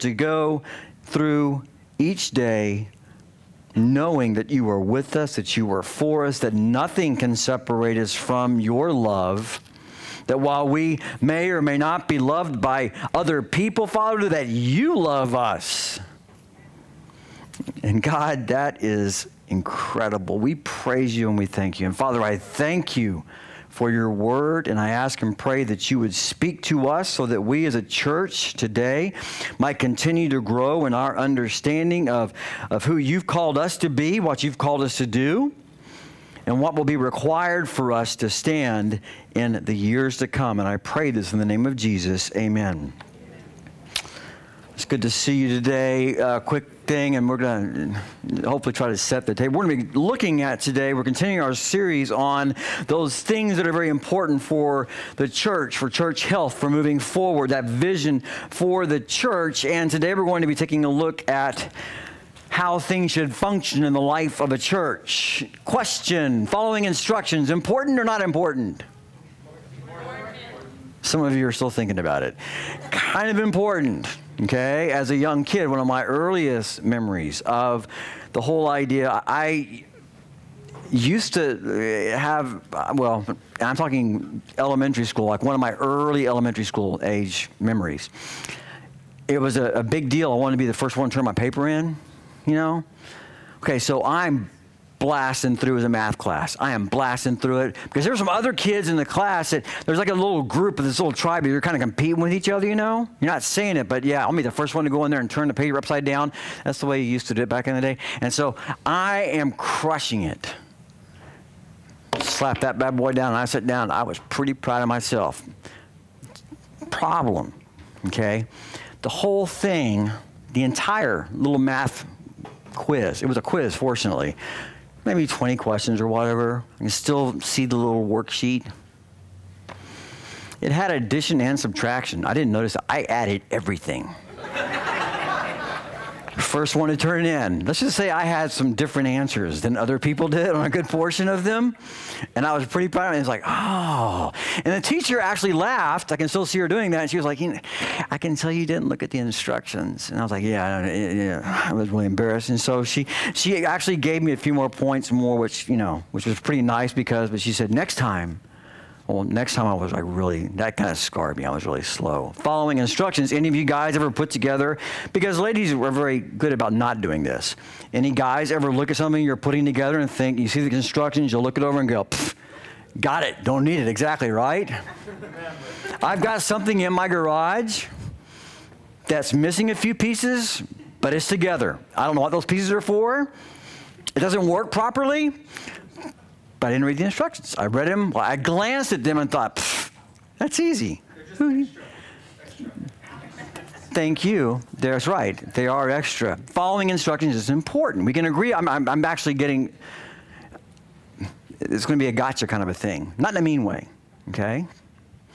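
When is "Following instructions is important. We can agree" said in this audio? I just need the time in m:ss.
3:16.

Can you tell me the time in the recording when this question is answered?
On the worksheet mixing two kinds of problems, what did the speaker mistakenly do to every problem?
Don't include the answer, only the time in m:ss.
2:12.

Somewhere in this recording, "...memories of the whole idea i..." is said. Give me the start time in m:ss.
1:16.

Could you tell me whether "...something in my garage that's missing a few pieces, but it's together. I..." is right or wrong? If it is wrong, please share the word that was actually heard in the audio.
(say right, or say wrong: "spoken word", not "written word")
right.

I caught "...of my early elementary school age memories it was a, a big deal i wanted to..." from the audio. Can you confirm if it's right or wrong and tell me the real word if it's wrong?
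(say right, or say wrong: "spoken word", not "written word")
right.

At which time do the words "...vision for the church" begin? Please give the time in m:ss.
0:57.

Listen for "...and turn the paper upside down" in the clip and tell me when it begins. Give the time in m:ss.
1:45.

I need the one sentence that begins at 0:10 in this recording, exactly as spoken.
That while we may or may not be loved by other people, Father, that you love us.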